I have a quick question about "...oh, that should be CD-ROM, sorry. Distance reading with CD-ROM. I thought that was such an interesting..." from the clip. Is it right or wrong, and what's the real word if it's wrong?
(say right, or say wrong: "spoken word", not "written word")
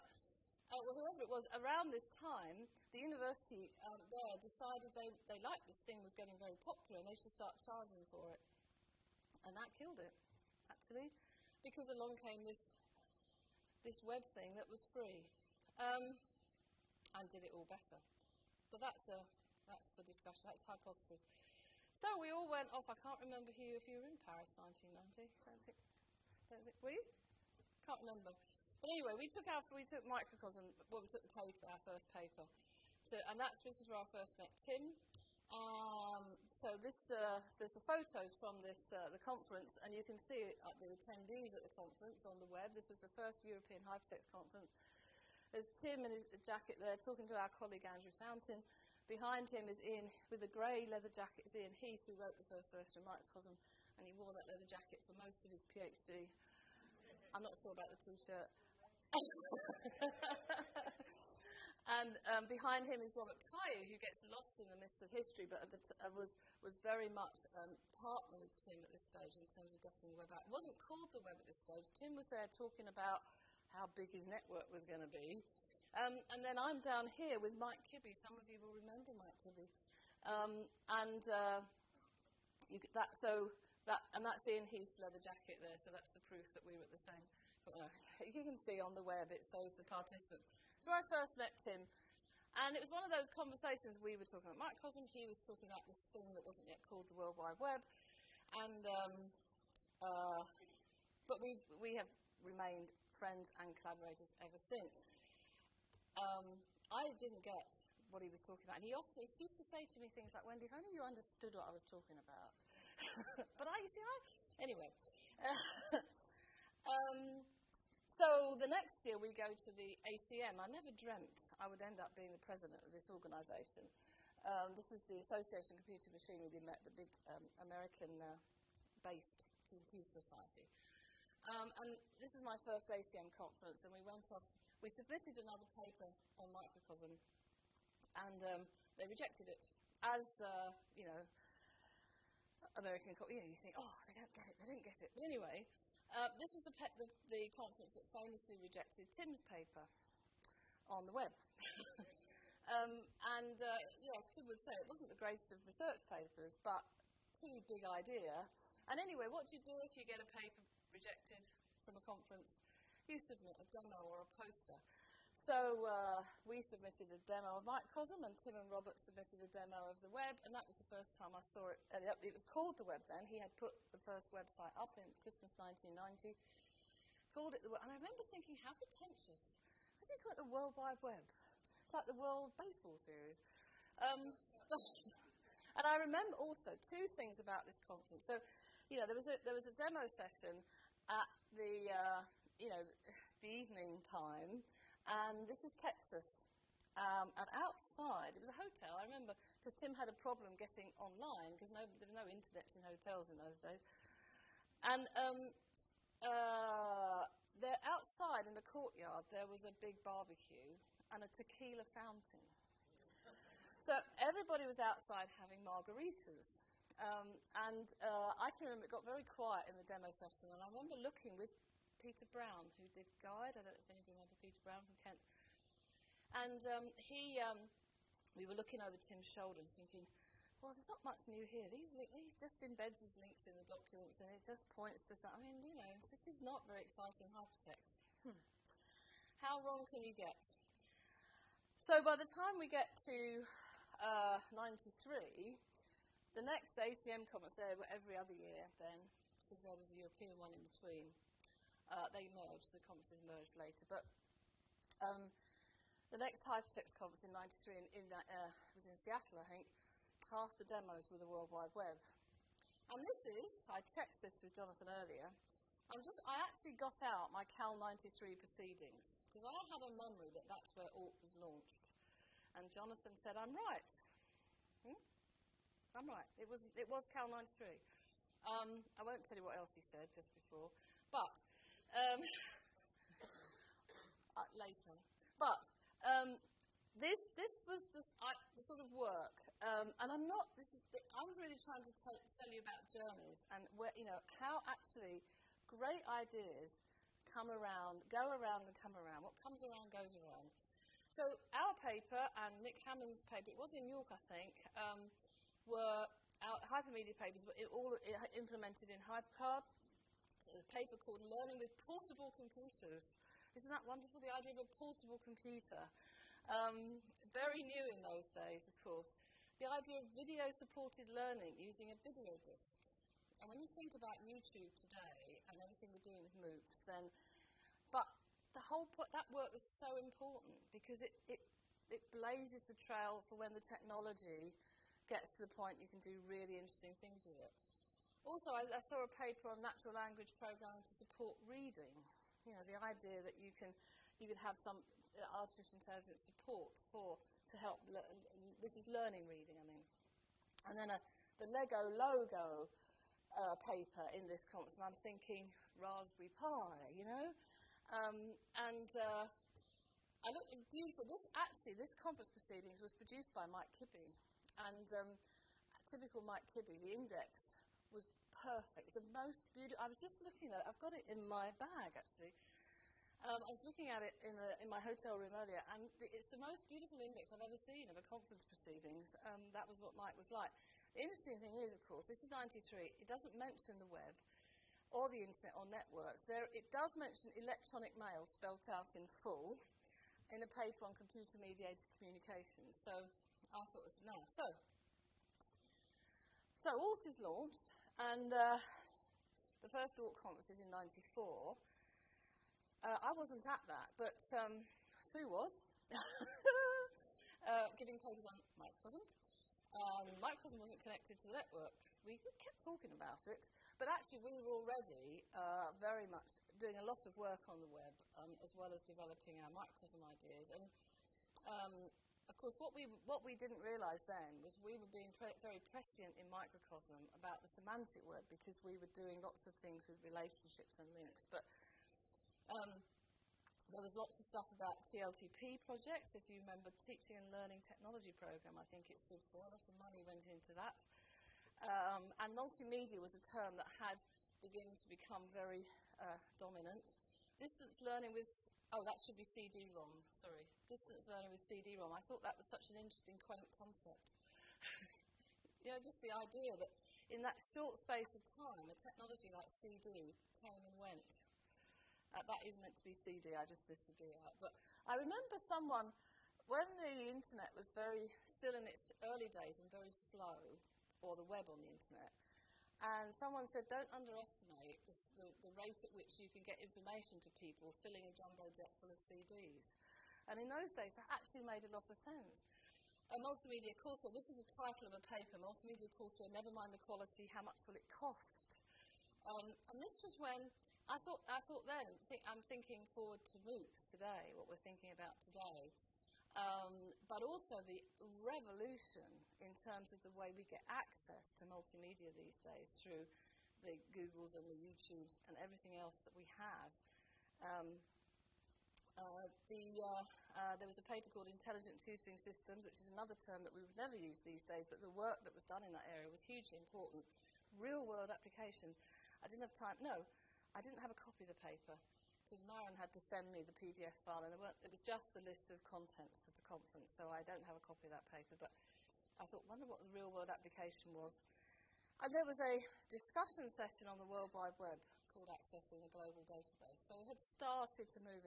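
wrong: "learning", not "reading".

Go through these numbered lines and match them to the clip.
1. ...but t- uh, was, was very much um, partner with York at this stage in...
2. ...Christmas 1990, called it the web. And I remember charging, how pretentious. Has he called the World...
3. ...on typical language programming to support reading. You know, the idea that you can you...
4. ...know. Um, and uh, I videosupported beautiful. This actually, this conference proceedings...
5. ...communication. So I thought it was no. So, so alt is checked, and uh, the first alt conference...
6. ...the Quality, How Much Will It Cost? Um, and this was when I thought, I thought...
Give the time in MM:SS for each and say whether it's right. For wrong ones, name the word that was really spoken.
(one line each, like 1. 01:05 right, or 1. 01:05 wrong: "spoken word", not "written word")
1. 01:05 wrong: "Tim", not "York"
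2. 02:55 wrong: "thinking", not "charging"
3. 05:39 wrong: "natural", not "typical"
4. 05:57 wrong: "looked", not "videosupported"
5. 06:31 wrong: "launched", not "checked"
6. 08:06 right.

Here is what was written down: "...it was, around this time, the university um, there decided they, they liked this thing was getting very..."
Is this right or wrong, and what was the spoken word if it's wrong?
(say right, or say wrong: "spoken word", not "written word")
right.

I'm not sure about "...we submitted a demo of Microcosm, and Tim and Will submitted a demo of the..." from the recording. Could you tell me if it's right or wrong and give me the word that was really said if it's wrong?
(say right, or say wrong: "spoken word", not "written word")
wrong: "Robert", not "Will".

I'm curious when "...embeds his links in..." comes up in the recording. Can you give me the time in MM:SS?
03:52.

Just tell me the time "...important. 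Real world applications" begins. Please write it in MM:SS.
08:36.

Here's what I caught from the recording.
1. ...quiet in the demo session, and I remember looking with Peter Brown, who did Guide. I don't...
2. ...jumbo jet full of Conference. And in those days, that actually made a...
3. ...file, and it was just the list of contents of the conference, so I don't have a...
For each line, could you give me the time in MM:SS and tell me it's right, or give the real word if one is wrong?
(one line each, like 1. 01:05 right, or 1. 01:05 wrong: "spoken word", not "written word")
1. 03:39 right
2. 07:58 wrong: "CDs", not "Conference"
3. 08:44 right.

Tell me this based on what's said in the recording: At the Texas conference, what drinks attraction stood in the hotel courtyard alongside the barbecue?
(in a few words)
a tequila fountain.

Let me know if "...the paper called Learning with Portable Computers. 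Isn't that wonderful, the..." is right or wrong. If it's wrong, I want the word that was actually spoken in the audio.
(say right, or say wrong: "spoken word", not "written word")
right.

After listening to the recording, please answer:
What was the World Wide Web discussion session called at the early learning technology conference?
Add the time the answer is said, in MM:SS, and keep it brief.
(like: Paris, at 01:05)
Accessing a Global Database, at 08:55.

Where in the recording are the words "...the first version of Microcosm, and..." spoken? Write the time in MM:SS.
00:52.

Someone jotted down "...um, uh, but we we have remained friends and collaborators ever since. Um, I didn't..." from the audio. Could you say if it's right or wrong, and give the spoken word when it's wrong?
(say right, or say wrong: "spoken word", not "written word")
right.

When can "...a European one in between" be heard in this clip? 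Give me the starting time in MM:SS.
04:09.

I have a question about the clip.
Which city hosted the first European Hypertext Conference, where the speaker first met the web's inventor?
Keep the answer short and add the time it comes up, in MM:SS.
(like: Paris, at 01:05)
Paris, at 00:24.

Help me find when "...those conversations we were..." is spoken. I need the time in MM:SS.
01:33.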